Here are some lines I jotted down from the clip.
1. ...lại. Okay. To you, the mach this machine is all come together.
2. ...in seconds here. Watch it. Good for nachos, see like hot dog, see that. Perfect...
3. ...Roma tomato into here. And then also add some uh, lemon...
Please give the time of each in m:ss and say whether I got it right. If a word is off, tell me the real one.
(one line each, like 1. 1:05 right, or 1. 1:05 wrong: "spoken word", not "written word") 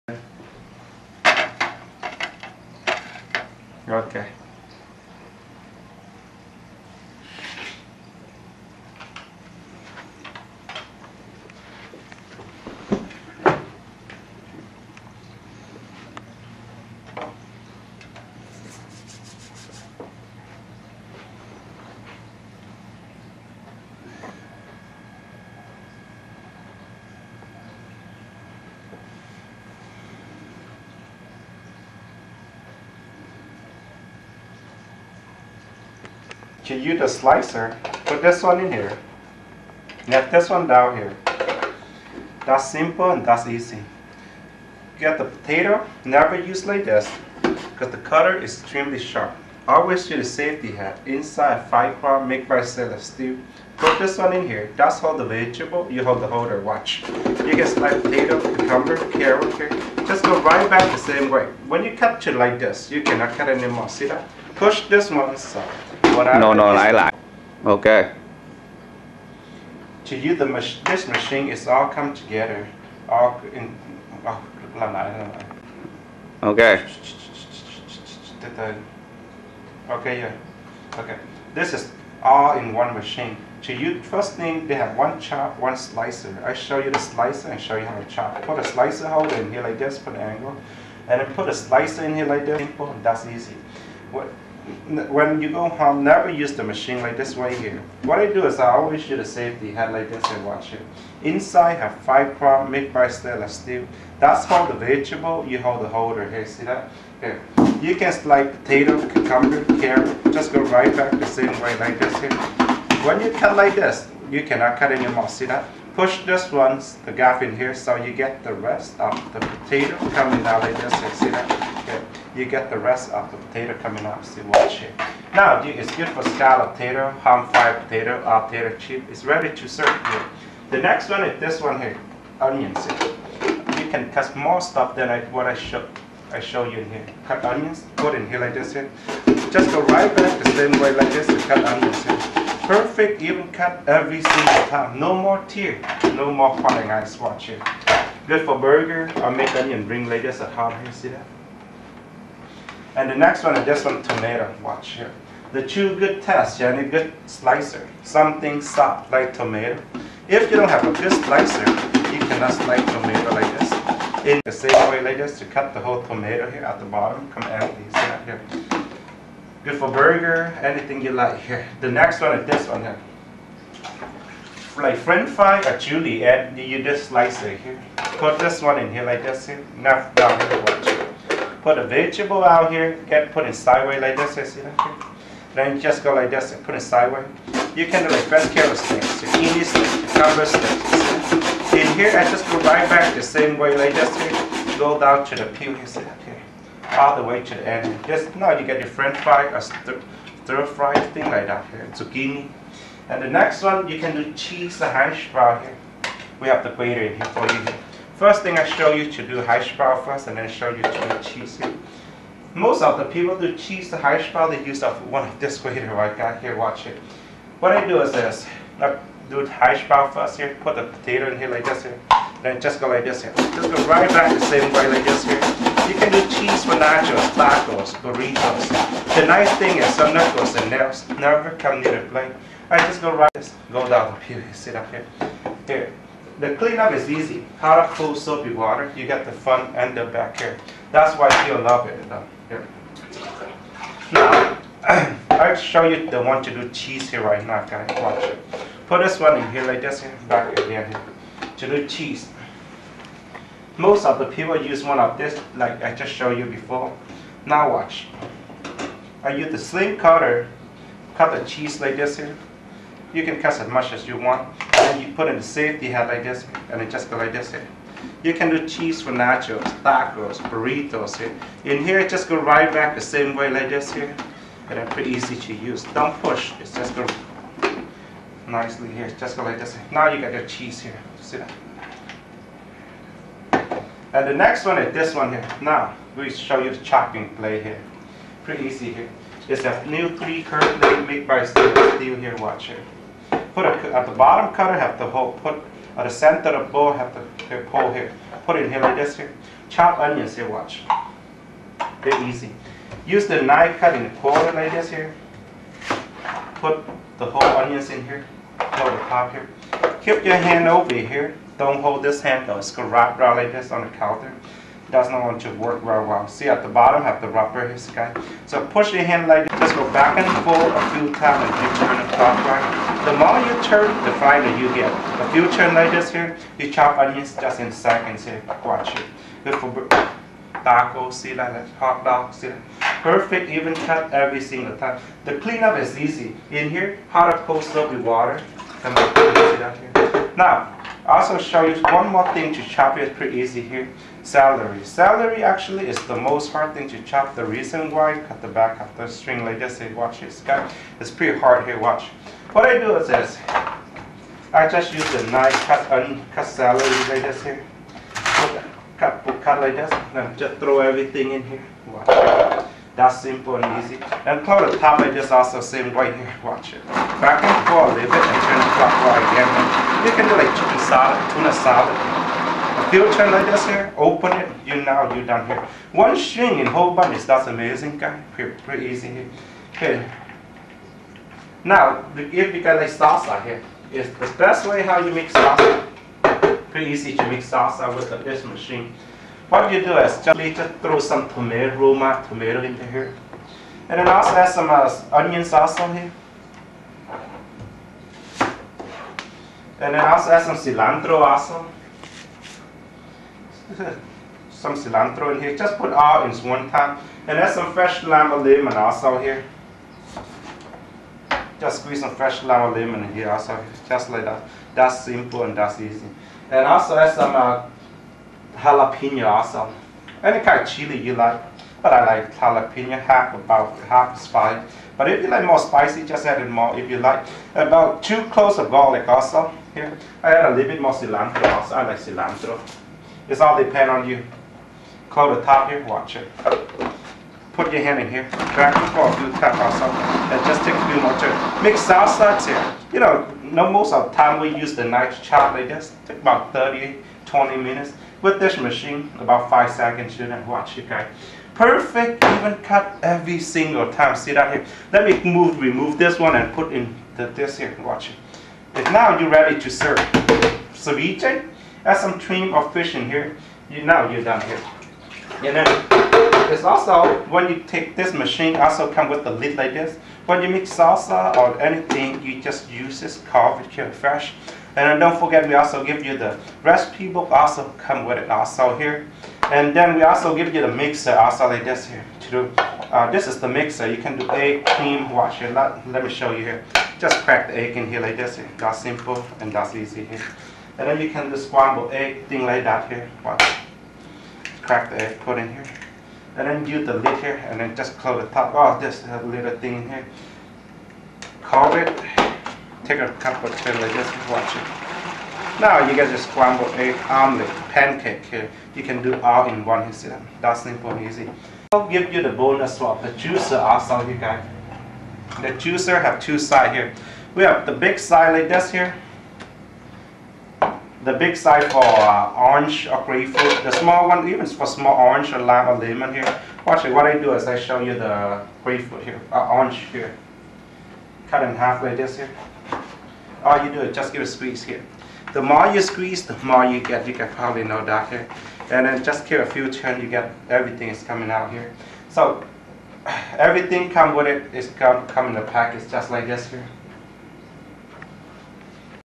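1. 1:06 right
2. 5:27 wrong: "tacos", not "nachos"
3. 6:31 wrong: "onion", not "lemon".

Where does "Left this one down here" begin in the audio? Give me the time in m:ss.
0:40.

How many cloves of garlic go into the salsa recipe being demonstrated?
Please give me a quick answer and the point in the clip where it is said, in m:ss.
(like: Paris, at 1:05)
2, at 7:08.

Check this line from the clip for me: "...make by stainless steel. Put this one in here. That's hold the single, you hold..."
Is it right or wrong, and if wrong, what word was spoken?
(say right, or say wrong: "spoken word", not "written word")
wrong: "vegetable", not "single".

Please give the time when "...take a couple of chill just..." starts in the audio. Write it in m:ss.
8:22.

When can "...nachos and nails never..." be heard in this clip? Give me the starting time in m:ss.
3:50.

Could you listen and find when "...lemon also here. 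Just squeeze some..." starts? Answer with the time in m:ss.
6:48.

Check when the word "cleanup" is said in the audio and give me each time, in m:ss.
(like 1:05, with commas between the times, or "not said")
3:56, 5:35.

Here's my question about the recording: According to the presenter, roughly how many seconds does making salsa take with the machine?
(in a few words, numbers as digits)
5 seconds.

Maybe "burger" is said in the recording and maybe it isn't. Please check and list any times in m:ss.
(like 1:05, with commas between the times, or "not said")
2:28, 2:49.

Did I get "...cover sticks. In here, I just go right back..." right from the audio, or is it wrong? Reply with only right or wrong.
right.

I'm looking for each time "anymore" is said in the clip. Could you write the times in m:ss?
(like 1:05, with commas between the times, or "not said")
1:03.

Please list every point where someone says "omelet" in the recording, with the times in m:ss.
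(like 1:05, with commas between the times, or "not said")
8:27.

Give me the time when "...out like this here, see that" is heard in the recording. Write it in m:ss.
2:00.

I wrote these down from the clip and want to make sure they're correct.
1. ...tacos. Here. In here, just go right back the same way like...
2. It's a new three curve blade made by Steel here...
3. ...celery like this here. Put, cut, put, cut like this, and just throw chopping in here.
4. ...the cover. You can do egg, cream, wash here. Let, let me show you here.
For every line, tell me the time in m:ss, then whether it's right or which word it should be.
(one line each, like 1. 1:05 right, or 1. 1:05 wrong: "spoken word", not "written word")
1. 4:30 wrong: "burritos", not "tacos"
2. 4:49 right
3. 5:56 wrong: "everything", not "chopping"
4. 8:03 wrong: "mixer", not "cover".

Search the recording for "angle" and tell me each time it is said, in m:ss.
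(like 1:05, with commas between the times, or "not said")
1:30.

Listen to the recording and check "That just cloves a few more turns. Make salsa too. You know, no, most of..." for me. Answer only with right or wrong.
wrong.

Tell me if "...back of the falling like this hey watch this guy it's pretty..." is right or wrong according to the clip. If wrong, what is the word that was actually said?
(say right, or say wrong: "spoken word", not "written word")
wrong: "string", not "falling".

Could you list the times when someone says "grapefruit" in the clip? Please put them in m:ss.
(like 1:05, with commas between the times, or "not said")
8:43, 8:48.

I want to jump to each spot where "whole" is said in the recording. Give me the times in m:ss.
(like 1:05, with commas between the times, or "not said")
2:45, 5:07, 6:16.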